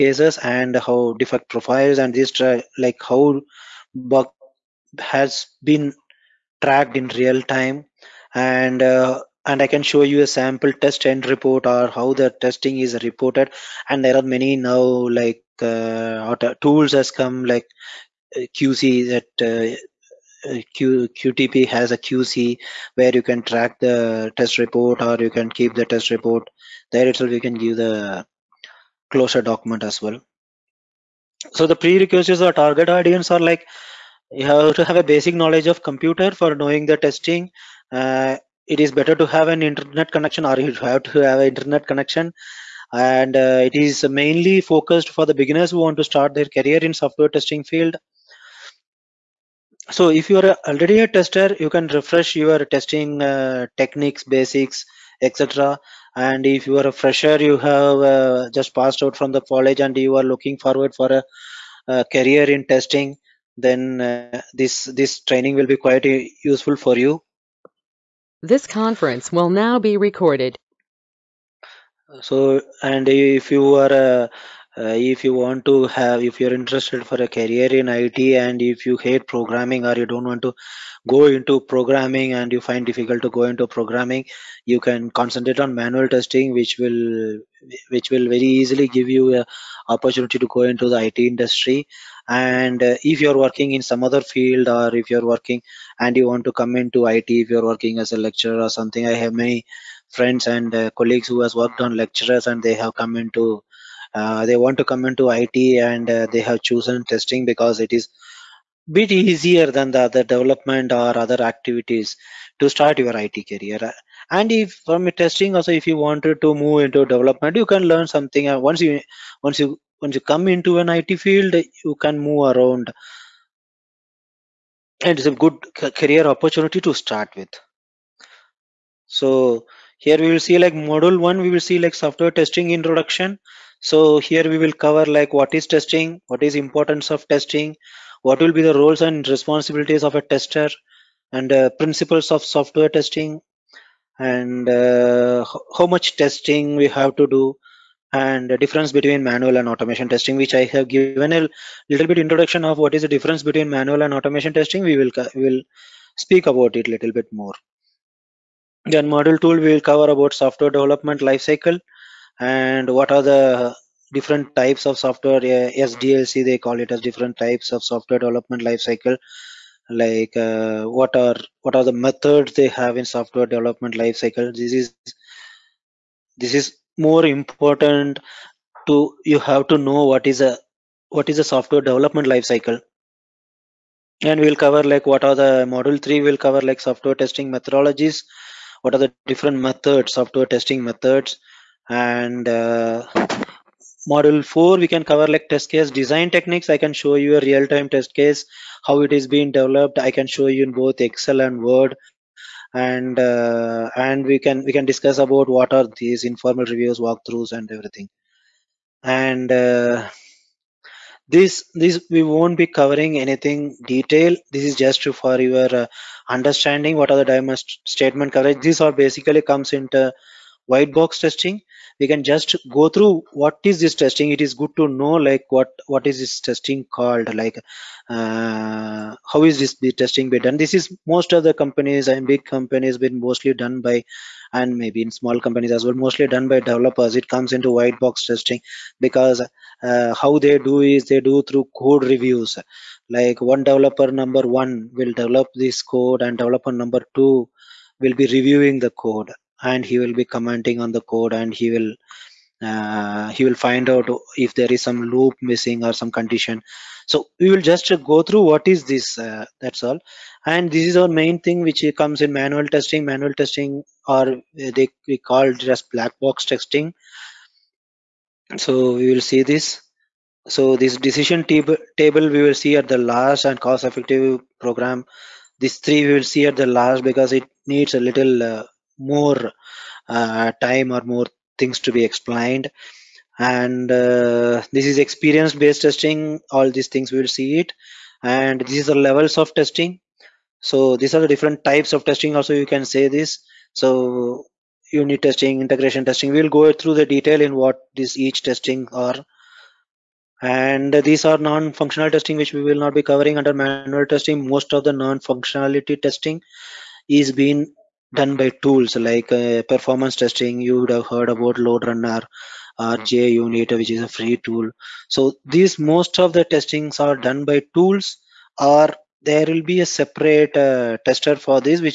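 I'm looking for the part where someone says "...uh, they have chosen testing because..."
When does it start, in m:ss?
1:46.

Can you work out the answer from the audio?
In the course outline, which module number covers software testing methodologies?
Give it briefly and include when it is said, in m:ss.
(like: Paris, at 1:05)
3, at 3:05.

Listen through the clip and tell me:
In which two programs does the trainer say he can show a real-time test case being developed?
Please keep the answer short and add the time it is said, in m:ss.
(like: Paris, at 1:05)
Excel and Word, at 3:20.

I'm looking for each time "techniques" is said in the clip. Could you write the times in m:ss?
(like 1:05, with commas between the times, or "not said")
0:53, 3:16.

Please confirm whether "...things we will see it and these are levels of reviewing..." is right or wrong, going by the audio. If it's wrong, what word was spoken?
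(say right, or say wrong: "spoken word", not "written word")
wrong: "testing", not "reviewing".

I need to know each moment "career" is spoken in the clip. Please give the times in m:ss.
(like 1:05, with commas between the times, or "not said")
0:46, 1:02, 1:17, 1:53, 2:05.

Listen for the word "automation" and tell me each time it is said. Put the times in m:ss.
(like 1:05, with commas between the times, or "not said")
2:29, 2:34.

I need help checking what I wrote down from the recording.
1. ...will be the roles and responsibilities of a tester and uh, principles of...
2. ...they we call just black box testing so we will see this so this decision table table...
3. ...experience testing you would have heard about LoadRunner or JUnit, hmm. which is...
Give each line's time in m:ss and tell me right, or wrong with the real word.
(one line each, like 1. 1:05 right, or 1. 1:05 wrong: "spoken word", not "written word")
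1. 2:18 right
2. 4:24 right
3. 5:09 wrong: "performance", not "experience".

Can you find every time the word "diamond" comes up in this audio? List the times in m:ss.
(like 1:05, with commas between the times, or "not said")
3:37.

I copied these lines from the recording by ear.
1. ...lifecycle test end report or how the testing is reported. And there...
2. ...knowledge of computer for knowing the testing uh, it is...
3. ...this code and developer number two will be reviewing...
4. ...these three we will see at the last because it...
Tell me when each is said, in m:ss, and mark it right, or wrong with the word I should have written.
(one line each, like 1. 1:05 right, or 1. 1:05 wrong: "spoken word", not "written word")
1. 0:10 wrong: "sample", not "lifecycle"
2. 0:35 right
3. 4:05 right
4. 4:35 right.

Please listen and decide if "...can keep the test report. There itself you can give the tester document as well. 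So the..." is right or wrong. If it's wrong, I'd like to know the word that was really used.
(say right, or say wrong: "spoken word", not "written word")
wrong: "closer", not "tester".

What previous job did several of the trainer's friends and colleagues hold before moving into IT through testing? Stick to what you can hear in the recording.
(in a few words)
Lecturer.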